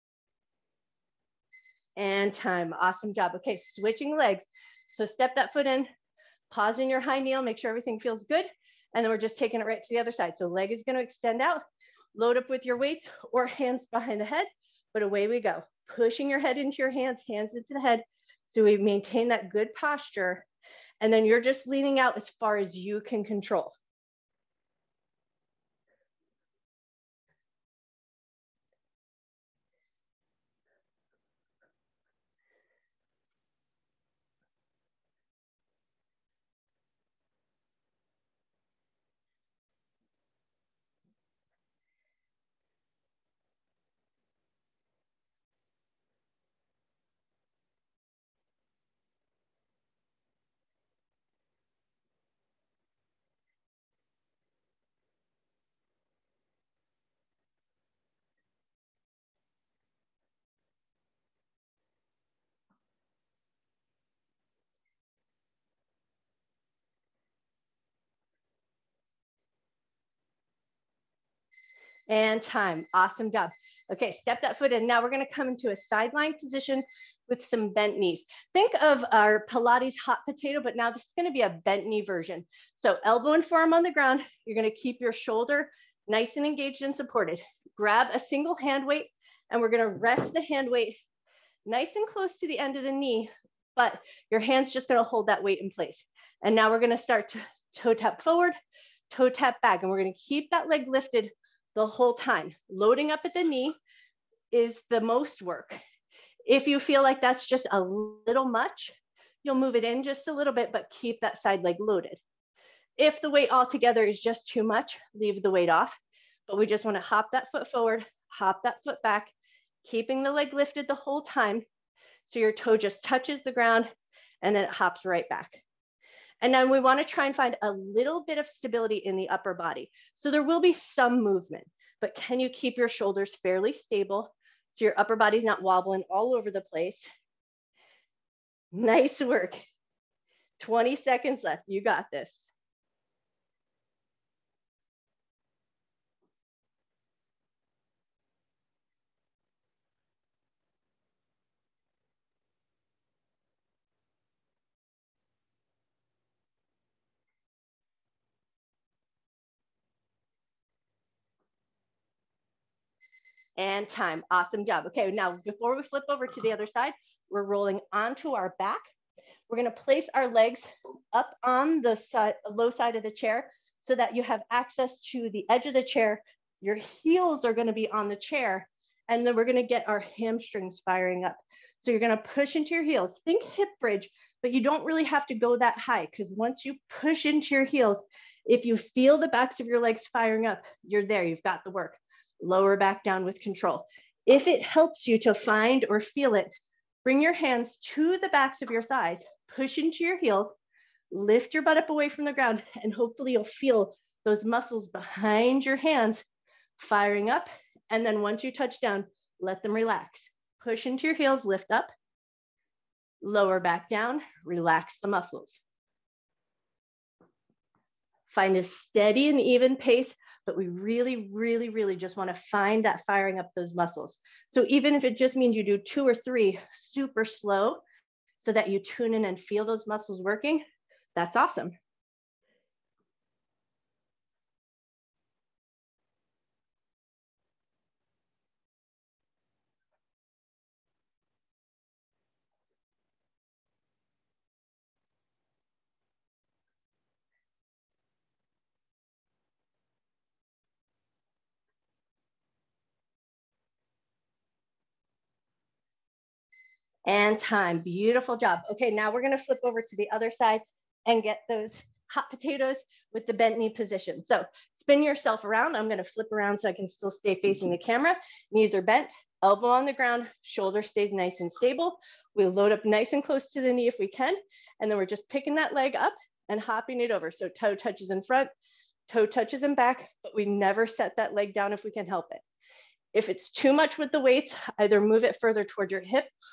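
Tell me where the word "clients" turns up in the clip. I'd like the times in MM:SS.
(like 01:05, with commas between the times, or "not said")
not said.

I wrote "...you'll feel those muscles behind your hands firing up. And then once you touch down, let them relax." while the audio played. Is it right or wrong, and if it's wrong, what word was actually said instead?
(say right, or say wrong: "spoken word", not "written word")
right.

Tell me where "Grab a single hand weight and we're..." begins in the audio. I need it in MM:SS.
01:27.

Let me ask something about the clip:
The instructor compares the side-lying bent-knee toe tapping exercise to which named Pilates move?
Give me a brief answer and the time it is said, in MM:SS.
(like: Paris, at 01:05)
hot potato, at 01:19.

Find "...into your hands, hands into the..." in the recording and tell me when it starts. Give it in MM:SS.
00:16.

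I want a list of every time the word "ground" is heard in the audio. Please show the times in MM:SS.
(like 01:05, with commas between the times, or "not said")
01:23, 02:03, 03:22, 04:29.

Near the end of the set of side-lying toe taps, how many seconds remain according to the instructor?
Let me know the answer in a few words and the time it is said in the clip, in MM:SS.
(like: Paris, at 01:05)
20, at 02:20.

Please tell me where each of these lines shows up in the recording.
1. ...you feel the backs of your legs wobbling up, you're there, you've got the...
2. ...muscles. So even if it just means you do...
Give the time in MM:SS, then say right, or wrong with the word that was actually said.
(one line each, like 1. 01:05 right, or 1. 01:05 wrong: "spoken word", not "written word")
1. 03:08 wrong: "firing", not "wobbling"
2. 03:43 right.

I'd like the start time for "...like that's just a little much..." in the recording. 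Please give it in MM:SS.
01:47.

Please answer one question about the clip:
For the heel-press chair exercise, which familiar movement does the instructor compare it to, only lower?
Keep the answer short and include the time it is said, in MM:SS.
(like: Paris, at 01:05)
hip bridge, at 03:03.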